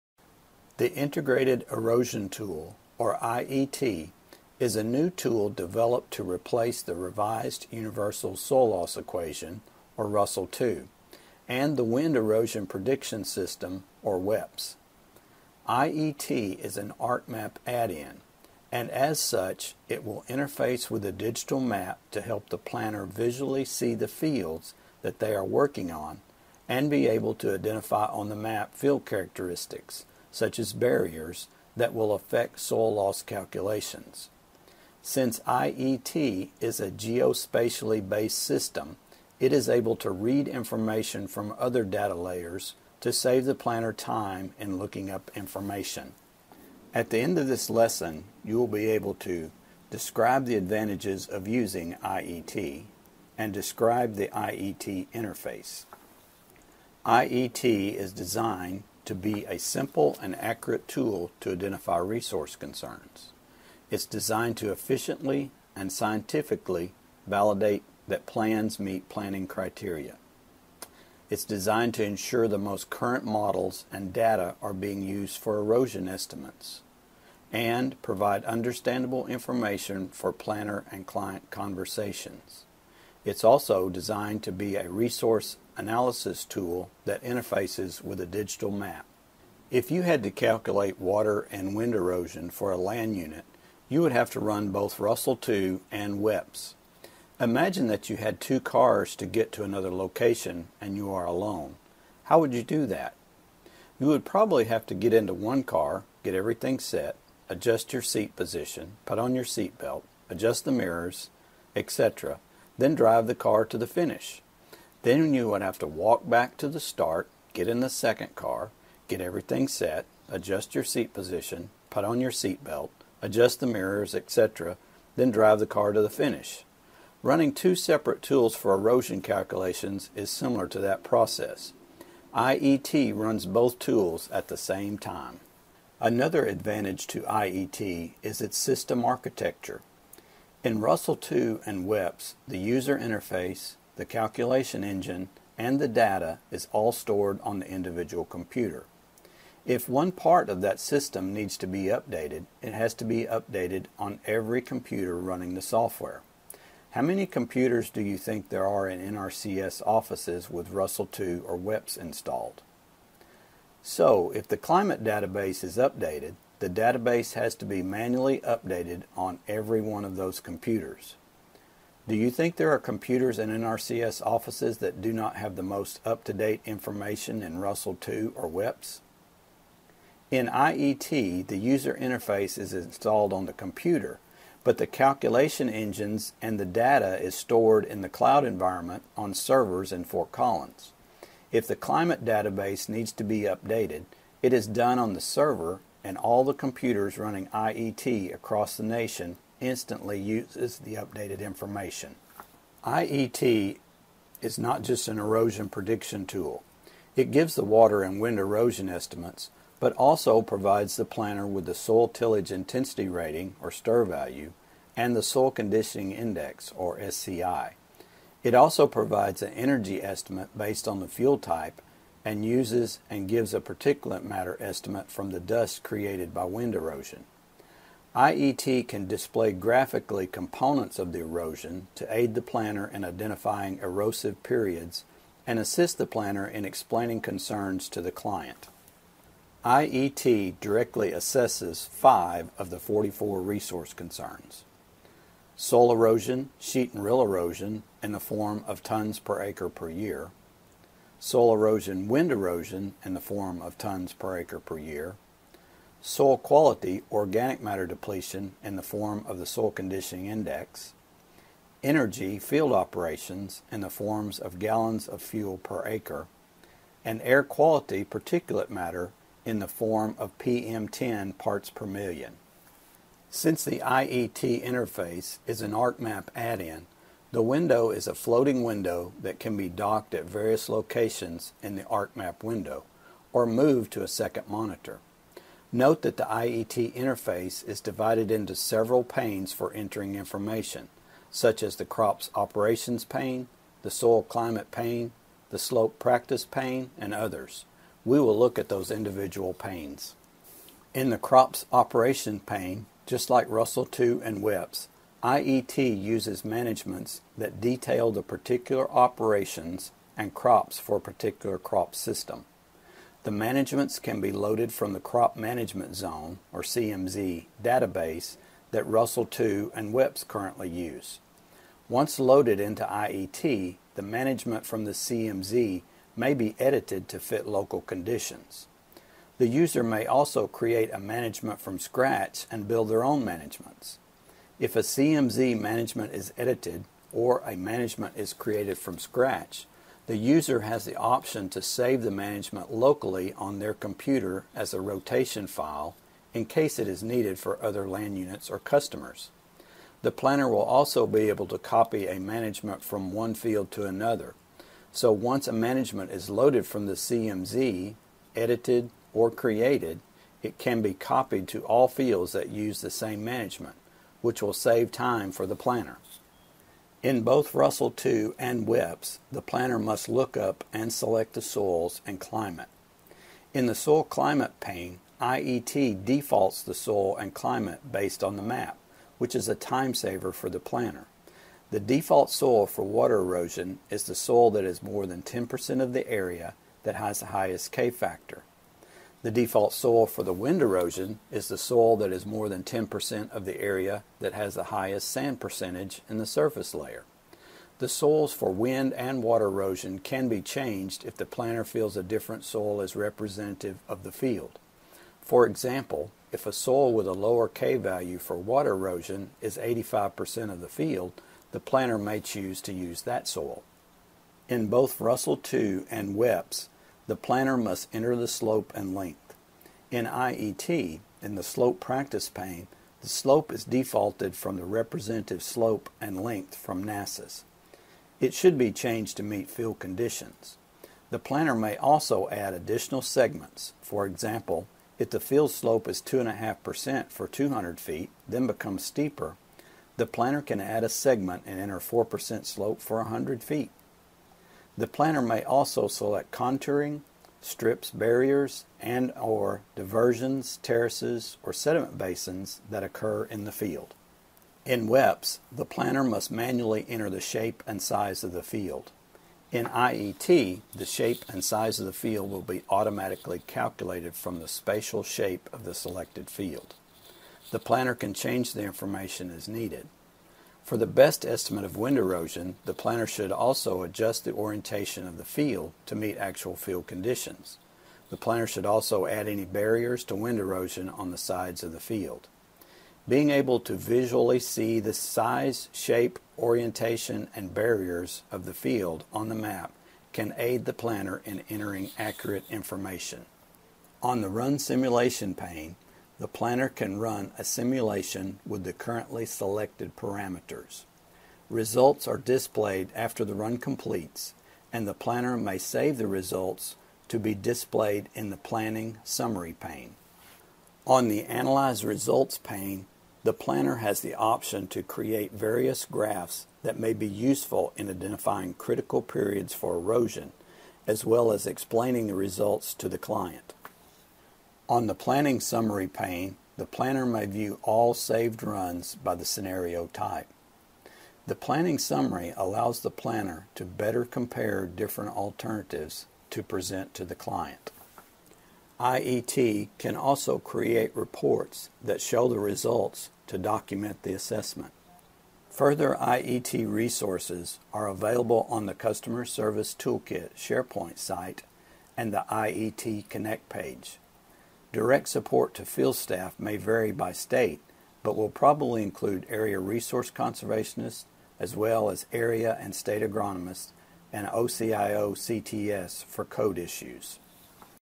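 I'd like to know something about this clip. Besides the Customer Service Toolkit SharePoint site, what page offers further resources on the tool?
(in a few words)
IET Connect.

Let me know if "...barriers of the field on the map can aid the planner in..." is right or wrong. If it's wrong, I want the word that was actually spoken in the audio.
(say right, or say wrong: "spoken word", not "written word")
right.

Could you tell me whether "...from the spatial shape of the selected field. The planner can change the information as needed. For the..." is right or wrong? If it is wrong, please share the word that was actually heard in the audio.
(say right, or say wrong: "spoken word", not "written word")
right.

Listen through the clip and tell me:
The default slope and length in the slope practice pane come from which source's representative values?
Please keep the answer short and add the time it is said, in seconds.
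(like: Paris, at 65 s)
NASIS, at 426 s.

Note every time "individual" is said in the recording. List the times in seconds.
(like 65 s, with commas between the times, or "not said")
147 s, 298 s.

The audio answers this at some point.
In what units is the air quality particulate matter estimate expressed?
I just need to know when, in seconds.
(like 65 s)
270 s.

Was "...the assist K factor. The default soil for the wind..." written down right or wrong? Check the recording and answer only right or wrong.
wrong.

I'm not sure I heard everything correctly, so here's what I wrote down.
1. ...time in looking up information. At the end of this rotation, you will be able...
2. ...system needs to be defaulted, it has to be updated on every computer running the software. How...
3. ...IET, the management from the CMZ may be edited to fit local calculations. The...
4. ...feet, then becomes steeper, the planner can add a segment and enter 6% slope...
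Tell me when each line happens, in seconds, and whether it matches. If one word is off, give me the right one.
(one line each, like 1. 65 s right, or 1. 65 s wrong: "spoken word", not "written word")
1. 43 s wrong: "lesson", not "rotation"
2. 150 s wrong: "updated", not "defaulted"
3. 322 s wrong: "conditions", not "calculations"
4. 437 s wrong: "4", not "6".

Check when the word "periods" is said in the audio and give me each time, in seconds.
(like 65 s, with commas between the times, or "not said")
234 s, 519 s.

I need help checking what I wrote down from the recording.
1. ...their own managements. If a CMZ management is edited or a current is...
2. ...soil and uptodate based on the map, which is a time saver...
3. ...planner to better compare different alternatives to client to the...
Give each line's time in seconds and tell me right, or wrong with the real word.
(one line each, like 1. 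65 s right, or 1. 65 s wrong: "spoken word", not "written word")
1. 332 s wrong: "management", not "current"
2. 376 s wrong: "climate", not "uptodate"
3. 532 s wrong: "present", not "client".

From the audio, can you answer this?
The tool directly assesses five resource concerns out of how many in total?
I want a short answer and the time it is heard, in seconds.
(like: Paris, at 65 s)
44, at 242 s.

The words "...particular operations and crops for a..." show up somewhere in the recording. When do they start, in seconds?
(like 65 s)
308 s.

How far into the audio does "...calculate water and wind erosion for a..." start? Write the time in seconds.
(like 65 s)
90 s.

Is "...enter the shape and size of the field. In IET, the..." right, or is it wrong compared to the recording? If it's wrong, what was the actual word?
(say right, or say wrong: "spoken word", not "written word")
right.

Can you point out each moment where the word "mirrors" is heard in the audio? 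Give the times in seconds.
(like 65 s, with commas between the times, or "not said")
110 s, 123 s.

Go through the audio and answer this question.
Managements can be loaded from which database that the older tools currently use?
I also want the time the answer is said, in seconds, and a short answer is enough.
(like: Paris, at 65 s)
Crop Management Zone, at 314 s.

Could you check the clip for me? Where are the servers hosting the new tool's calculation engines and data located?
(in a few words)
Fort Collins.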